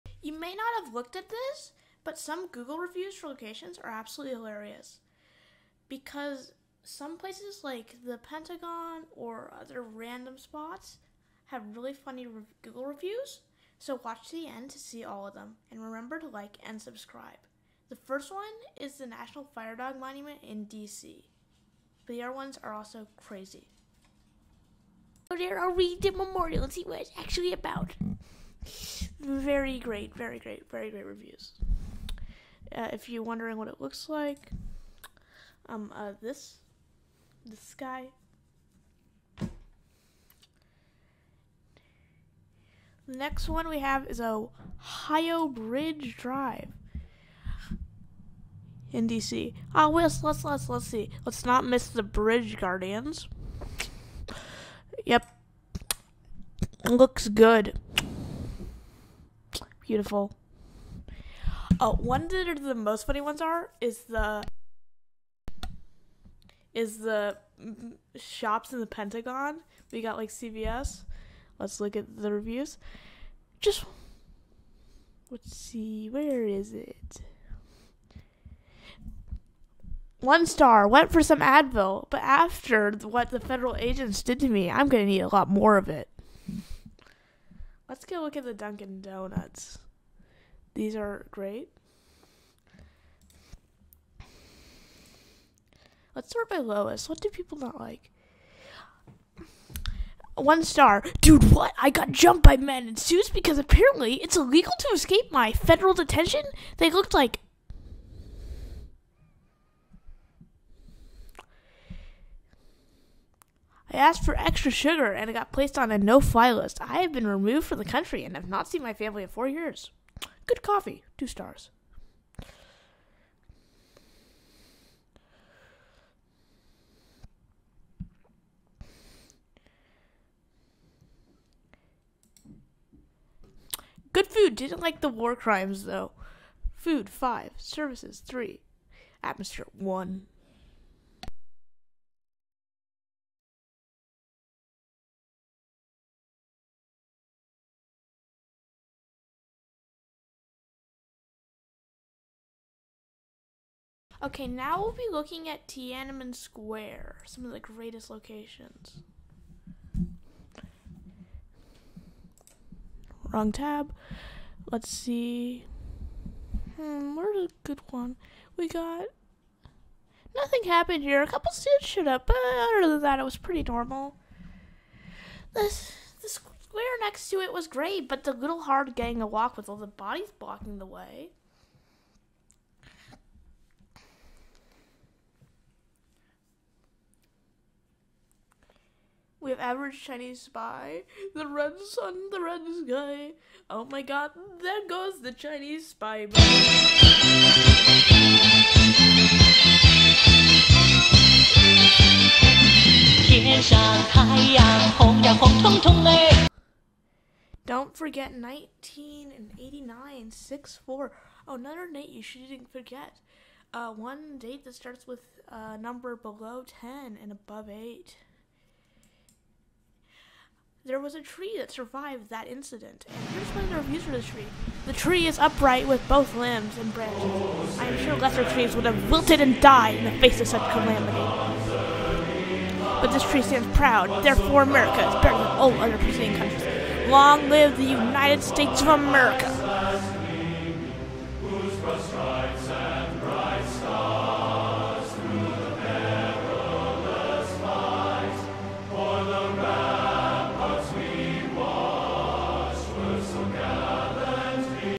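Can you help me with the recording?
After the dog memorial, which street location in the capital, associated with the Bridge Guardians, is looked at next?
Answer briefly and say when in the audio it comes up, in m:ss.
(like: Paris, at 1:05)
Ohio Bridge Drive, at 0:44.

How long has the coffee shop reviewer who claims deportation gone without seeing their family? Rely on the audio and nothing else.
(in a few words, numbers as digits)
4 years.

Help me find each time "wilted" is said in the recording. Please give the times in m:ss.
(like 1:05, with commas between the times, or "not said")
3:49.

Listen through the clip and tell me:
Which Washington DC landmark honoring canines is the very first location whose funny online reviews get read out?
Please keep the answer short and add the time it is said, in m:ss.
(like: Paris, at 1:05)
National Fire Dog Monument, at 0:19.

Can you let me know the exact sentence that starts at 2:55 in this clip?
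This, the square next to it was great, but the little hard getting a walk with all the bodies blocking the way.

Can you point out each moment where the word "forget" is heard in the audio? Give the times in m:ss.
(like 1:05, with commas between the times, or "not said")
3:27, 3:32.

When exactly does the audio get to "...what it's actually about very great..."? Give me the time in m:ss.
0:26.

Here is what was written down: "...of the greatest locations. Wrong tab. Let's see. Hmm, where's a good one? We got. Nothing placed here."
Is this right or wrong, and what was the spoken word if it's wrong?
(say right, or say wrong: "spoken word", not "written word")
wrong: "happened", not "placed".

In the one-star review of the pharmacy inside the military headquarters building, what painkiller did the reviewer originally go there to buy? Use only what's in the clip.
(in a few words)
Advil.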